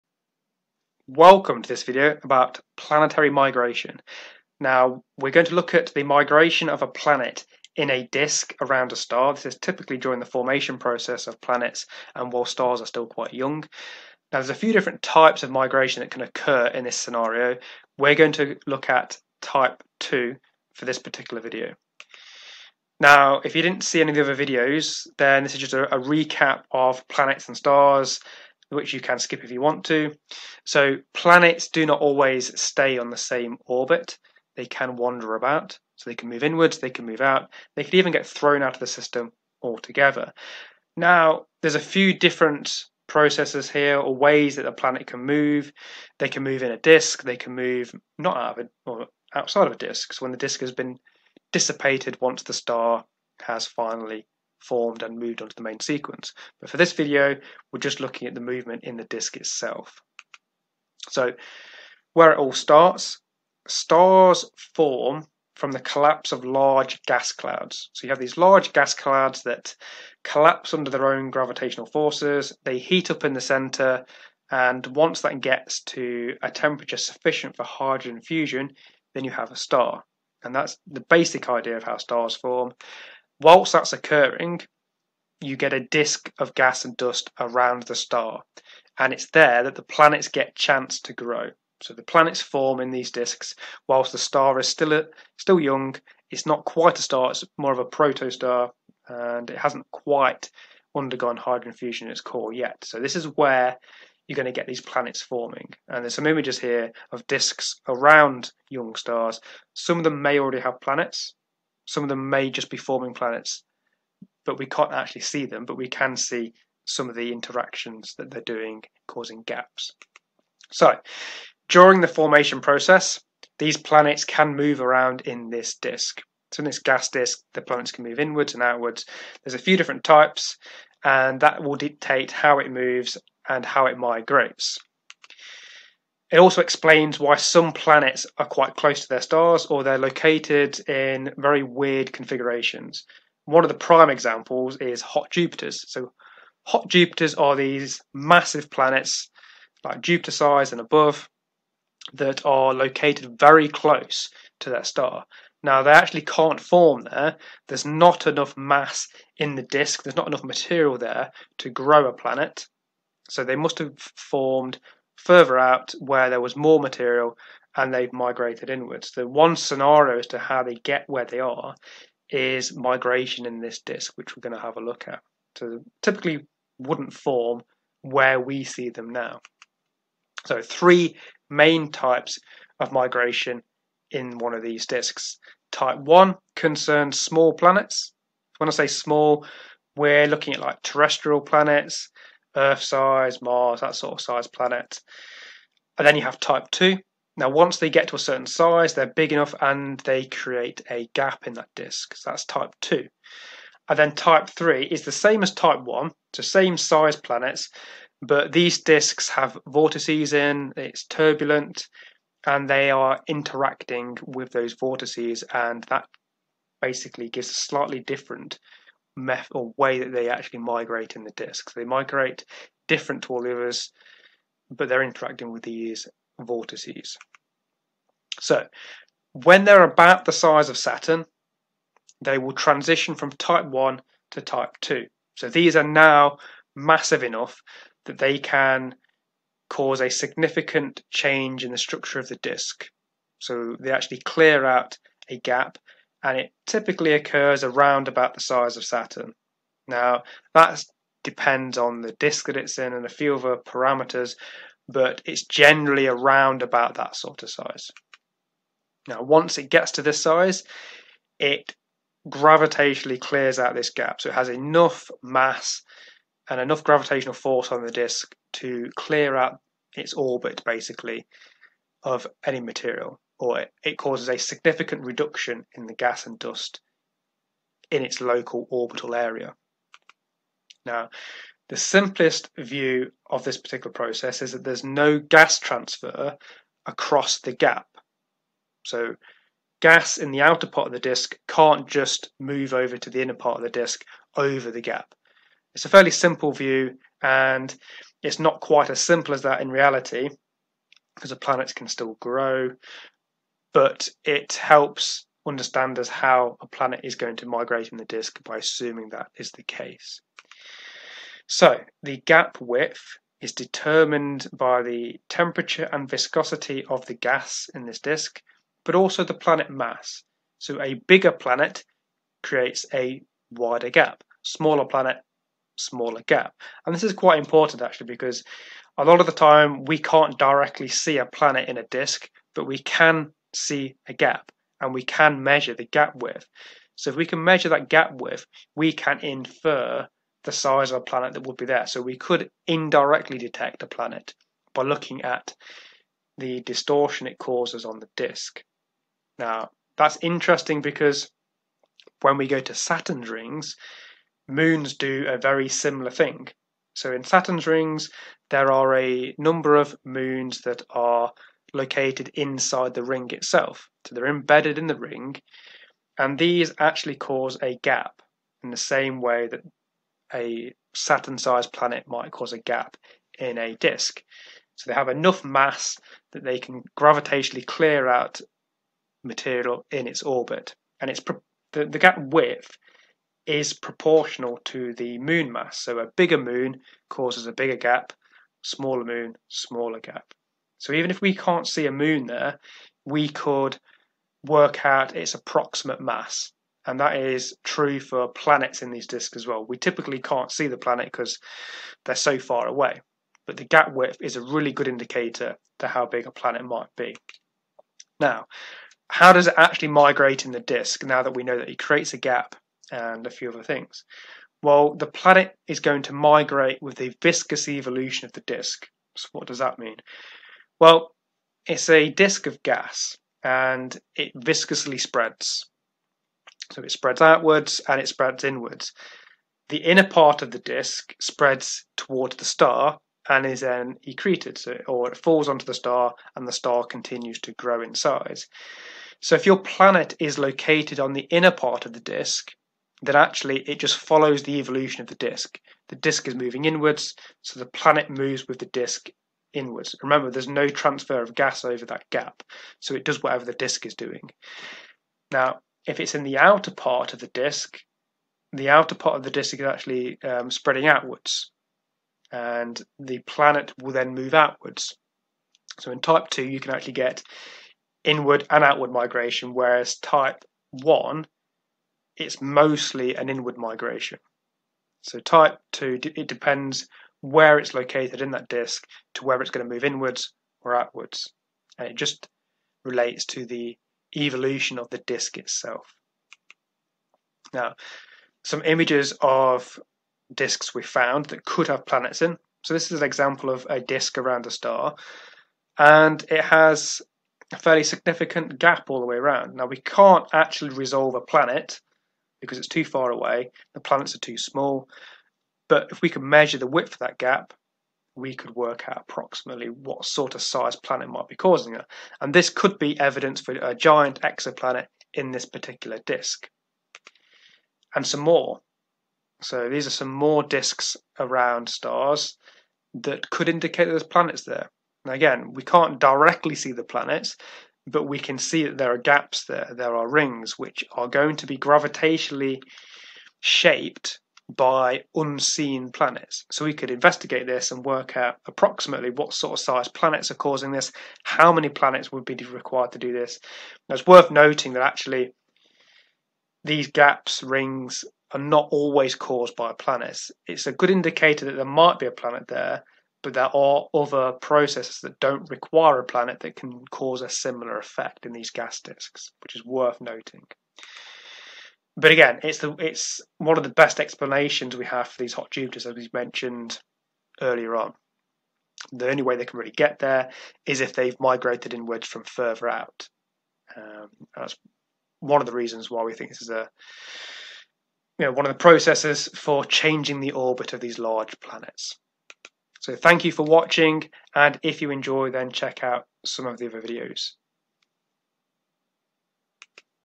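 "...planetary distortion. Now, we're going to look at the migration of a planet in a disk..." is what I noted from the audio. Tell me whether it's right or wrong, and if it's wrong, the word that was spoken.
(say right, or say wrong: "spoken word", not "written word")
wrong: "migration", not "distortion".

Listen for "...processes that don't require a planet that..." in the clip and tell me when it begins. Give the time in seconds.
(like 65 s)
554 s.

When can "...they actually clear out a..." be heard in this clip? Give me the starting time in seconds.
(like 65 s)
243 s.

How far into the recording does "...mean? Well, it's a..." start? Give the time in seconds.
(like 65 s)
419 s.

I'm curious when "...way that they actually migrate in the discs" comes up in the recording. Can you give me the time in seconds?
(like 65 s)
219 s.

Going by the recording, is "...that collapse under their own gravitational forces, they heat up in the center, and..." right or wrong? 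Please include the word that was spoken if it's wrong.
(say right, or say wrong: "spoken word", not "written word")
right.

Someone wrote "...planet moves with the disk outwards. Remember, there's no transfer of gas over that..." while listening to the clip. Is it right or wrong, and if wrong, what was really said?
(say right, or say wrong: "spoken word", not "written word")
wrong: "inwards", not "outwards".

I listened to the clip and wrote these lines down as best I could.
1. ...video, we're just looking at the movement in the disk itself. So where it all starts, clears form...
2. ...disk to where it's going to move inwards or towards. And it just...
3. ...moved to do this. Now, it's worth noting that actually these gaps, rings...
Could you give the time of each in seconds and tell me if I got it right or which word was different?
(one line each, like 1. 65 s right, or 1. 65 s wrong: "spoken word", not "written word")
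1. 56 s wrong: "stars", not "clears"
2. 478 s wrong: "outwards", not "towards"
3. 542 s wrong: "required", not "moved".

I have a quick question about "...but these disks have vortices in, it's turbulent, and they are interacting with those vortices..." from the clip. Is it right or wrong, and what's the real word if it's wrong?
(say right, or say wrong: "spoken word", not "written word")
right.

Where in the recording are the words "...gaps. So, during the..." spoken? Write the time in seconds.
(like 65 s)
119 s.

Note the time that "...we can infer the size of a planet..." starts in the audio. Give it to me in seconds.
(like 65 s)
338 s.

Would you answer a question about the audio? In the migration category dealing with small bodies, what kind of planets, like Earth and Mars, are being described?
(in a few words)
terrestrial planets.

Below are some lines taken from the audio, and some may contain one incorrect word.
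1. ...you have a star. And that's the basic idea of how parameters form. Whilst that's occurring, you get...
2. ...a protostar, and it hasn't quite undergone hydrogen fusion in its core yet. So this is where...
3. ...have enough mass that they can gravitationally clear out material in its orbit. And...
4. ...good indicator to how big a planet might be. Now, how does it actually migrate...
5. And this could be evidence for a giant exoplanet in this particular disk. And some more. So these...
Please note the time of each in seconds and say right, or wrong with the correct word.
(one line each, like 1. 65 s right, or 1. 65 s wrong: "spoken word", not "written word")
1. 79 s wrong: "stars", not "parameters"
2. 97 s right
3. 374 s right
4. 404 s right
5. 512 s right.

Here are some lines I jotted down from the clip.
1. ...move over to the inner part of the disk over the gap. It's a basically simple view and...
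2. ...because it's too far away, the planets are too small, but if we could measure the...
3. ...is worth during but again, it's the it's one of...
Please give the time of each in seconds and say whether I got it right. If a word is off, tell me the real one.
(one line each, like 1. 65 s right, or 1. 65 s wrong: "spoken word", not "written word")
1. 292 s wrong: "fairly", not "basically"
2. 502 s right
3. 559 s wrong: "noting", not "during".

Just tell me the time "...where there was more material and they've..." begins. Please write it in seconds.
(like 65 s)
165 s.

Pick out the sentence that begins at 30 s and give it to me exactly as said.
So planets do not always stay on the same orbit.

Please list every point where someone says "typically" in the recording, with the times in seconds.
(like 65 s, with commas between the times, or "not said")
9 s, 176 s, 246 s, 399 s.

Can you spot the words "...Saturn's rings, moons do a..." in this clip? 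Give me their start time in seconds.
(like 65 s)
352 s.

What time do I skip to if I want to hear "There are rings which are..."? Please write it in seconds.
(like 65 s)
529 s.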